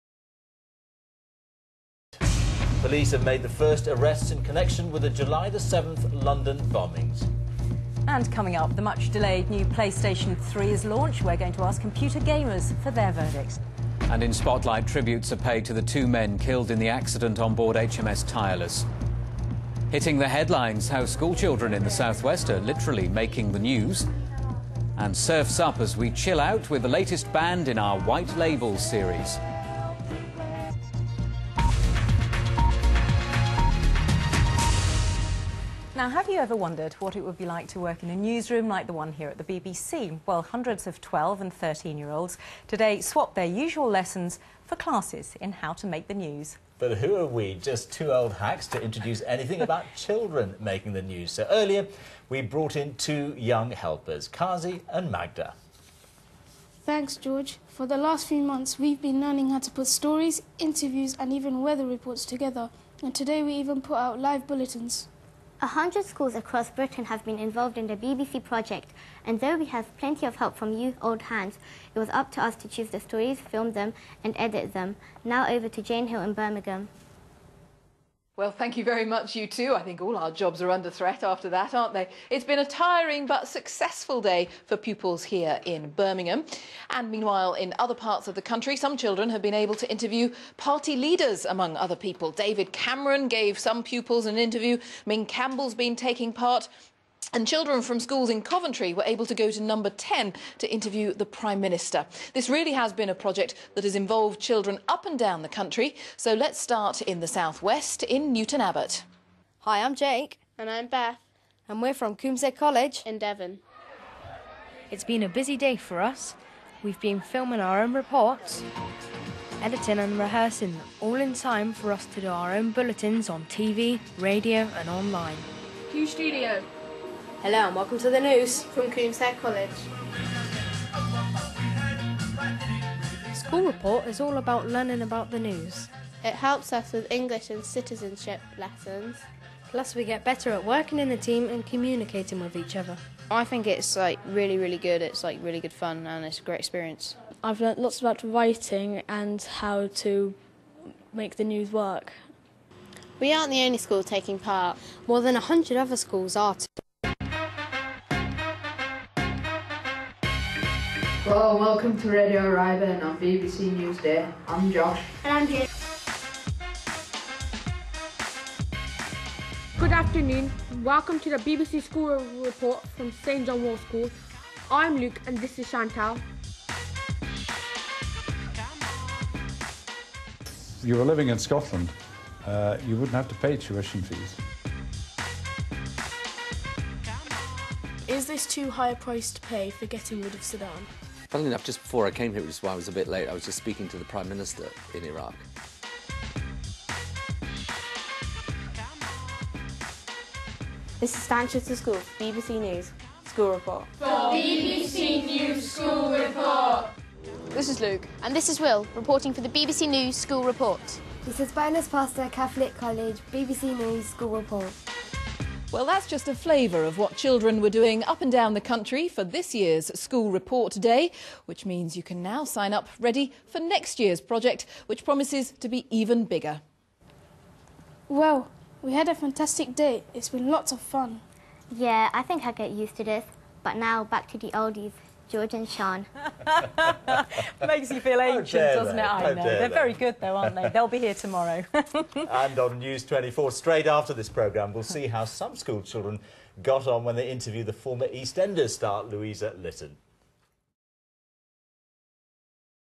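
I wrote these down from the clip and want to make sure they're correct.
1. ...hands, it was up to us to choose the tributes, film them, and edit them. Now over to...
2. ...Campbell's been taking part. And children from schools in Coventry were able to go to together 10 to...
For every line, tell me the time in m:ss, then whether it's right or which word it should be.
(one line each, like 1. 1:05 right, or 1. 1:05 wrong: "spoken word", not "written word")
1. 1:11 wrong: "stories", not "tributes"
2. 1:35 wrong: "number", not "together".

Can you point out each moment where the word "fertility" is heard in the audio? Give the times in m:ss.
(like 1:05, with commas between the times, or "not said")
not said.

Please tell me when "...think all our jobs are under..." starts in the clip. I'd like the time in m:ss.
1:19.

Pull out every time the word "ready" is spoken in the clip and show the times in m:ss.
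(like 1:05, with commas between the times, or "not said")
3:42.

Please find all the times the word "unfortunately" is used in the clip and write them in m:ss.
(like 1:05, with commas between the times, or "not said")
not said.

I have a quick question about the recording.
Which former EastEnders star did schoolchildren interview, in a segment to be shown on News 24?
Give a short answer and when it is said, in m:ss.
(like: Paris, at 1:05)
Louisa Lytton, at 4:09.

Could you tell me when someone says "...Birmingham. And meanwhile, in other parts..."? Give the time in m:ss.
1:25.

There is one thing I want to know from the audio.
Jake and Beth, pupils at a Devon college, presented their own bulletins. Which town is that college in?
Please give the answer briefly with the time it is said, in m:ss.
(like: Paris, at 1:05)
Newton Abbot, at 1:48.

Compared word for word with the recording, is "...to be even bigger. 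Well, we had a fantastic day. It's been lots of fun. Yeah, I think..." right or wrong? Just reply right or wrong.
right.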